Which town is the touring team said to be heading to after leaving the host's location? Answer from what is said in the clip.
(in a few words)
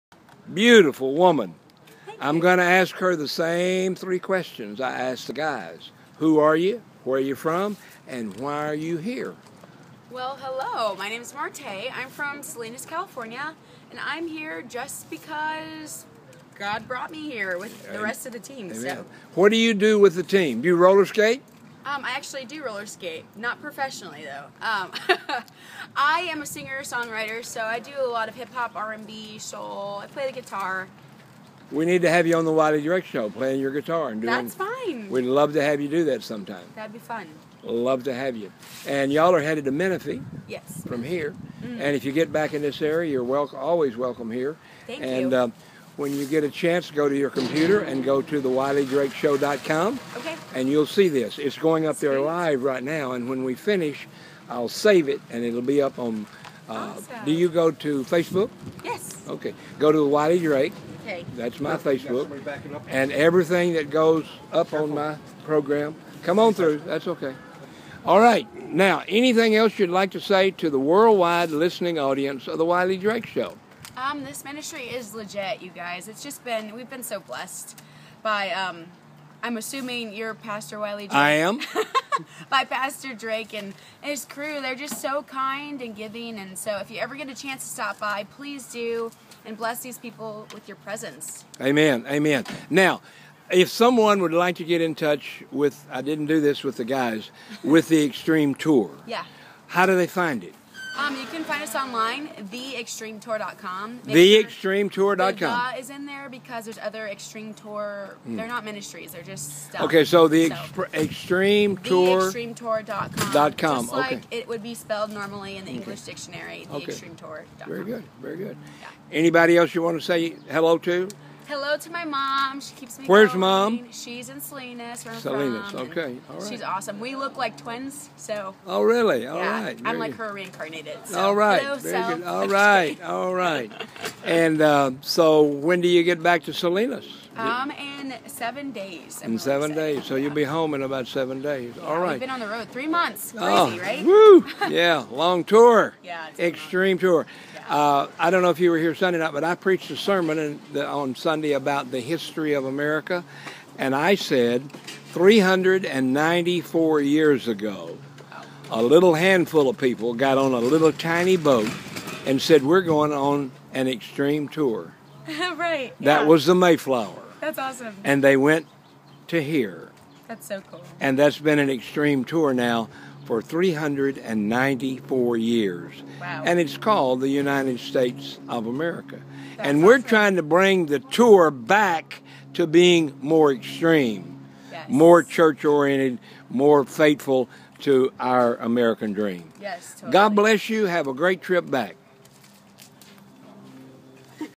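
Menifee.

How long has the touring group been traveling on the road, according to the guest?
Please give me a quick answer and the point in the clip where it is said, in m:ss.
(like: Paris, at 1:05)
3 months, at 2:22.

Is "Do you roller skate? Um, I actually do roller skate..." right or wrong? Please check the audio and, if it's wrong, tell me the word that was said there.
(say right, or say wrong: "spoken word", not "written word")
right.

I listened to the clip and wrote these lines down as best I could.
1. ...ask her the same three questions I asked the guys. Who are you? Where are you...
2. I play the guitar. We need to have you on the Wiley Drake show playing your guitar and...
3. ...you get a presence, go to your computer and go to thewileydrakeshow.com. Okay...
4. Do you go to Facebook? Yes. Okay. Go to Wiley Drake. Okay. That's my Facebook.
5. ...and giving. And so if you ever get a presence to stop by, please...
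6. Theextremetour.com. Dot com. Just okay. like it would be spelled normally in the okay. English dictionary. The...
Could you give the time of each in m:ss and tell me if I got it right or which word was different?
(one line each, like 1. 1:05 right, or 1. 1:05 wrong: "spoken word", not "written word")
1. 0:02 right
2. 0:30 right
3. 0:46 wrong: "chance", not "presence"
4. 0:57 right
5. 1:25 wrong: "chance", not "presence"
6. 1:52 right.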